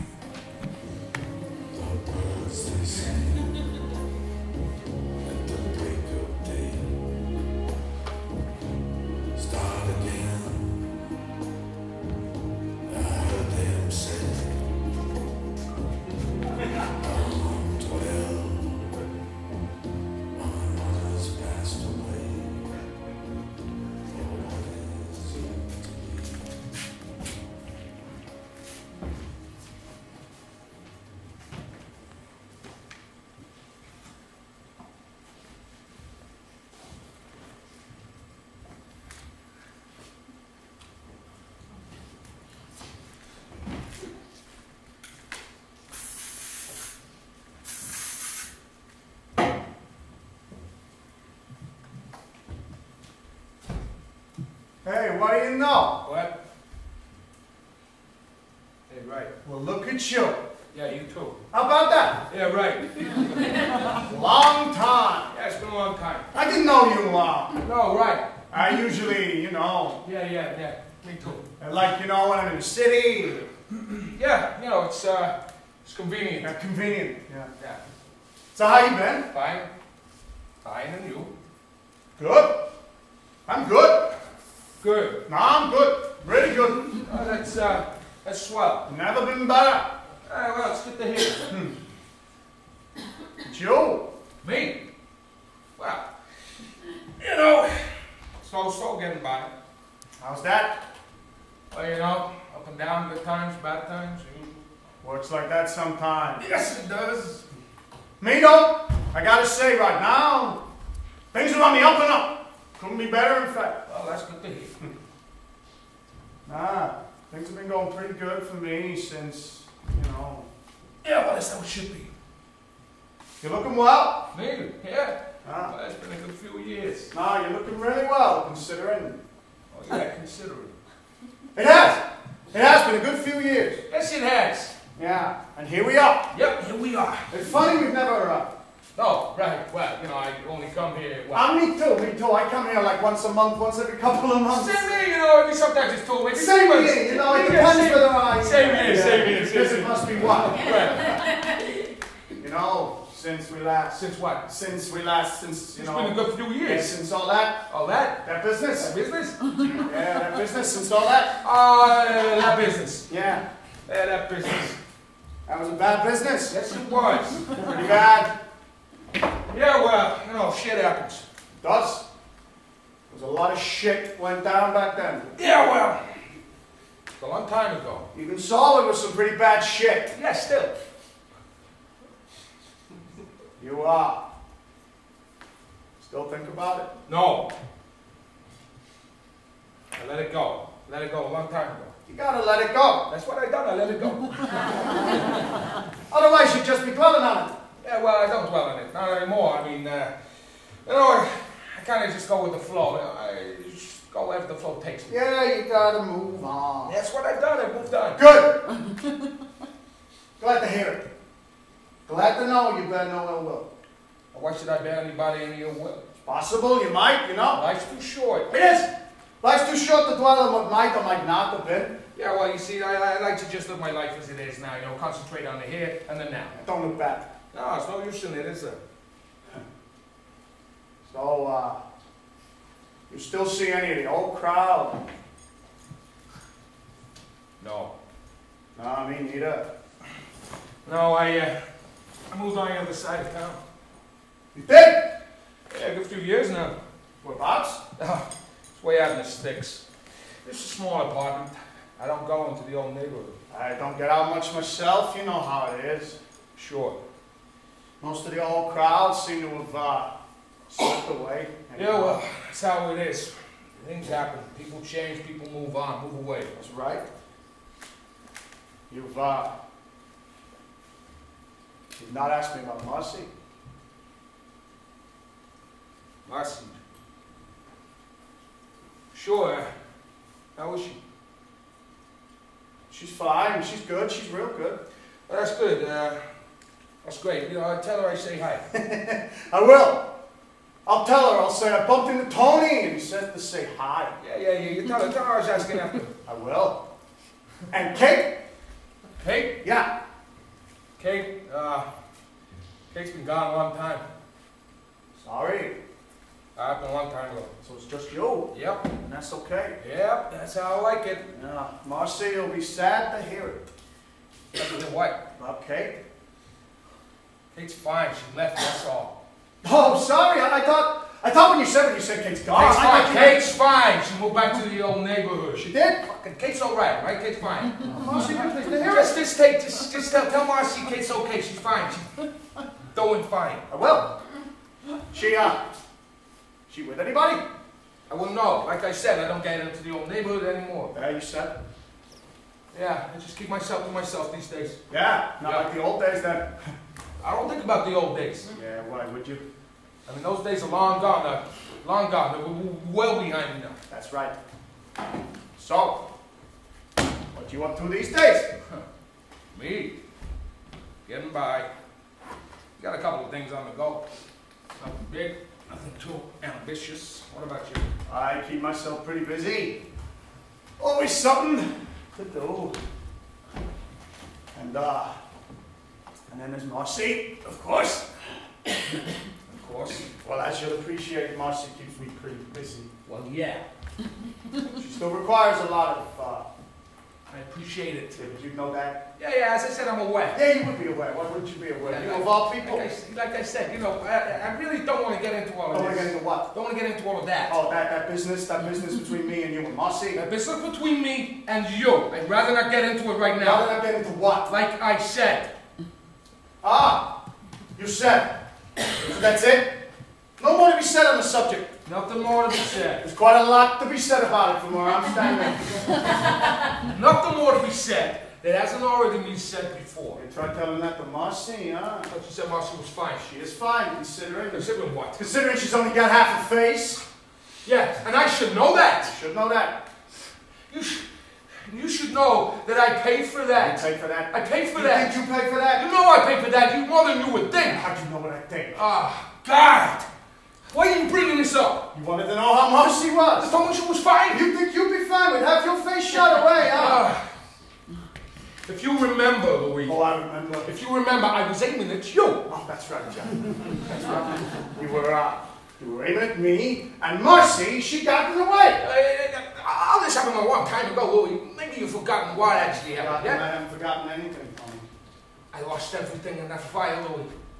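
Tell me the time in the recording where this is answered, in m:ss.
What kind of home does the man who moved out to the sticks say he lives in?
4:10.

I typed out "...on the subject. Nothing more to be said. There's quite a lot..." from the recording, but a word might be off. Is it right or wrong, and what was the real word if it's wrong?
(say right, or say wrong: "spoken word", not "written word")
right.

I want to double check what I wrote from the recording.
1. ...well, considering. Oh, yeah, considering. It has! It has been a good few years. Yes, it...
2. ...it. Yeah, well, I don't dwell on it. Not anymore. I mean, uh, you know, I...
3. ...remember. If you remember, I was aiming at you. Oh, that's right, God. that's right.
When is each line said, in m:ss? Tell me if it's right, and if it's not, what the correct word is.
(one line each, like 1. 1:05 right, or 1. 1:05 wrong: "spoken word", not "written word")
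1. 2:08 right
2. 3:17 right
3. 7:30 wrong: "Jack", not "God".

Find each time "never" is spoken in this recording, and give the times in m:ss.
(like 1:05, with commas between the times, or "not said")
1:28, 2:17.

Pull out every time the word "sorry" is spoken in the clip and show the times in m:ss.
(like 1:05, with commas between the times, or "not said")
5:05, 5:19.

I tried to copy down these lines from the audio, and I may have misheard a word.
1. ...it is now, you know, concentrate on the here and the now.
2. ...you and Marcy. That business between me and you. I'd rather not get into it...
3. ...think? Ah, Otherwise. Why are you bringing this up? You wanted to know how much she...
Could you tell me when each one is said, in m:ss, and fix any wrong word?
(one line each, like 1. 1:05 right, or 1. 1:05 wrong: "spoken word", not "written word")
1. 3:44 right
2. 6:39 right
3. 7:18 wrong: "God", not "Otherwise".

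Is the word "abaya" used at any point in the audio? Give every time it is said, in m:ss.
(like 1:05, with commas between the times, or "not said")
not said.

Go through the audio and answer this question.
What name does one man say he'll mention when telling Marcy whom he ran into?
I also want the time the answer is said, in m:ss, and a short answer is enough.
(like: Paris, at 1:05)
Tony, at 4:52.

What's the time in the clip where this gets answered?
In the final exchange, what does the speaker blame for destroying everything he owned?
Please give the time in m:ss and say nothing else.
7:46.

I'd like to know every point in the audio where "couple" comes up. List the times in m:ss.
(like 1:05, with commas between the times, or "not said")
2:23, 6:03.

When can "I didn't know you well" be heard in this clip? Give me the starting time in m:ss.
1:06.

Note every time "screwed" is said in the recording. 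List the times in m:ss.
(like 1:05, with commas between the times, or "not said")
not said.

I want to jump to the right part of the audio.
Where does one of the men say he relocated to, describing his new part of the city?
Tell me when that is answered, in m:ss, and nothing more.
4:02.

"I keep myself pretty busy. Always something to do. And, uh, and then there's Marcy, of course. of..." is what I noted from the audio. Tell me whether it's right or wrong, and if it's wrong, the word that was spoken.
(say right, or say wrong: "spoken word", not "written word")
right.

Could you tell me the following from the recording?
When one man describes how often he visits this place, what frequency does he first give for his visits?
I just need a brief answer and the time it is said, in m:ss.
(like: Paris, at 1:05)
Once a month, at 2:23.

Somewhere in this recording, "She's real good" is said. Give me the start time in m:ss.
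4:44.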